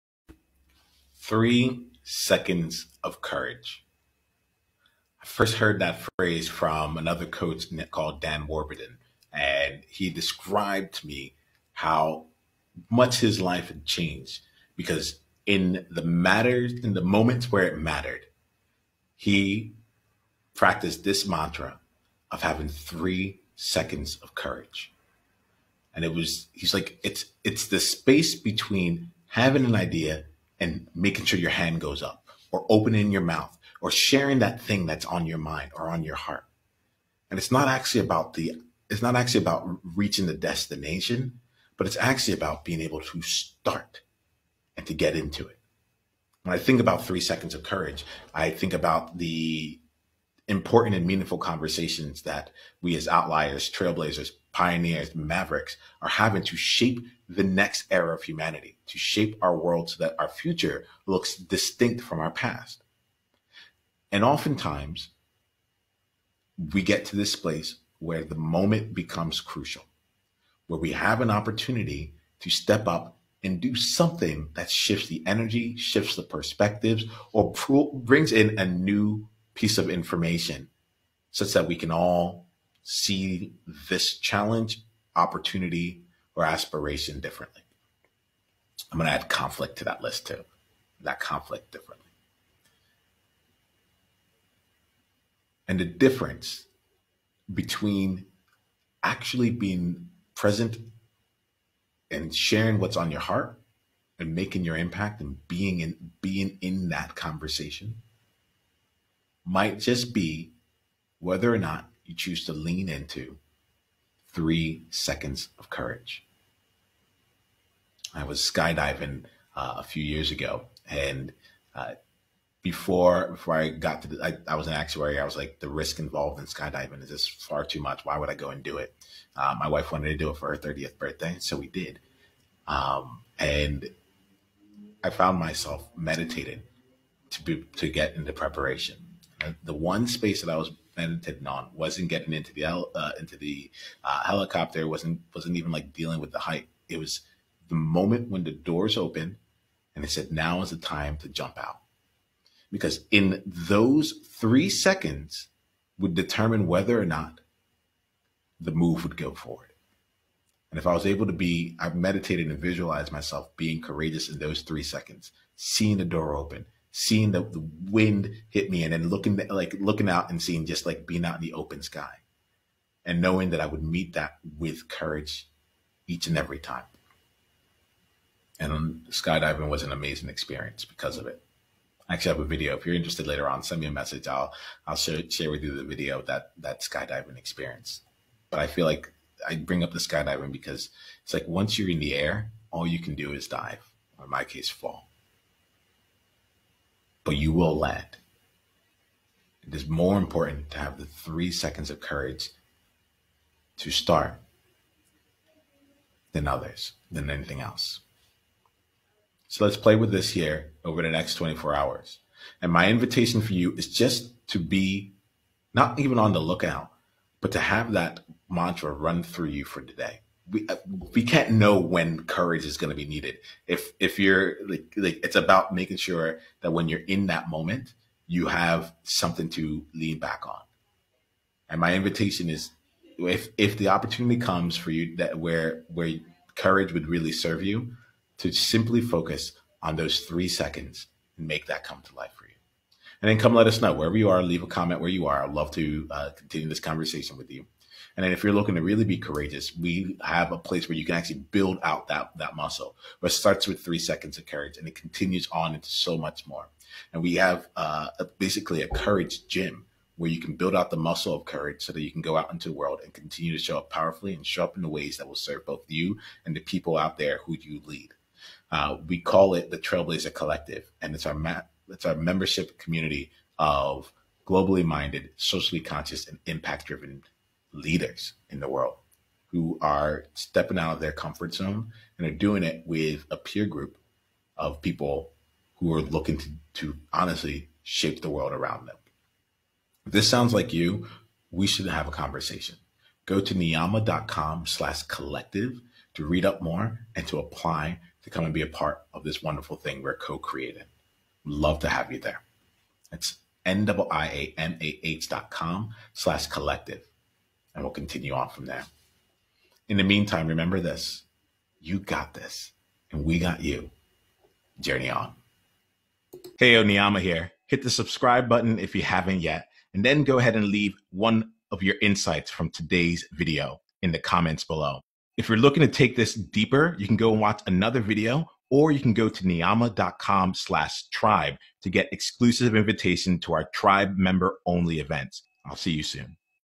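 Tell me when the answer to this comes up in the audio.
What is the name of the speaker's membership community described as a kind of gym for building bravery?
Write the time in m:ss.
4:29.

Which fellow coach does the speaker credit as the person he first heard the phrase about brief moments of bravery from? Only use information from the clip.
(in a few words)
Dan Warburton.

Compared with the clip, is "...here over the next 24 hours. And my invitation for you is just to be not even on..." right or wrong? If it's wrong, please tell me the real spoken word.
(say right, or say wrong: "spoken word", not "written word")
right.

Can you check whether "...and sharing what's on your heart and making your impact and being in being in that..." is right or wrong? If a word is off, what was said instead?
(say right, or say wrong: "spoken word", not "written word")
right.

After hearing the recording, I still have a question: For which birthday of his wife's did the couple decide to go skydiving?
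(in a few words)
Thirtieth.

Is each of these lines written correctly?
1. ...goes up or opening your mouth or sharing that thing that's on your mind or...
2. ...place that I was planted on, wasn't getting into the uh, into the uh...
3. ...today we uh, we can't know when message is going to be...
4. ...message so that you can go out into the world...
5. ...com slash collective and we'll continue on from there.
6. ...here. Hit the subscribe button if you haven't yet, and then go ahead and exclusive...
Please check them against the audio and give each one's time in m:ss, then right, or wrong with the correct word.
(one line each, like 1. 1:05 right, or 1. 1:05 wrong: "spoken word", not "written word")
1. 0:31 right
2. 2:20 wrong: "space", not "place"
3. 3:39 wrong: "courage", not "message"
4. 4:21 wrong: "courage", not "message"
5. 5:05 right
6. 5:17 wrong: "leave", not "exclusive".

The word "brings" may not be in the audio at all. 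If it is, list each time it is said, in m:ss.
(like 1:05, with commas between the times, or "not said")
1:17, 3:09.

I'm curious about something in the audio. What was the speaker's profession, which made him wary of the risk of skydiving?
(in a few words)
Actuary.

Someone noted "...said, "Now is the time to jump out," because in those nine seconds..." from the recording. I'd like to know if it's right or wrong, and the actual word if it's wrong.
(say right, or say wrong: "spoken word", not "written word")
wrong: "three", not "nine".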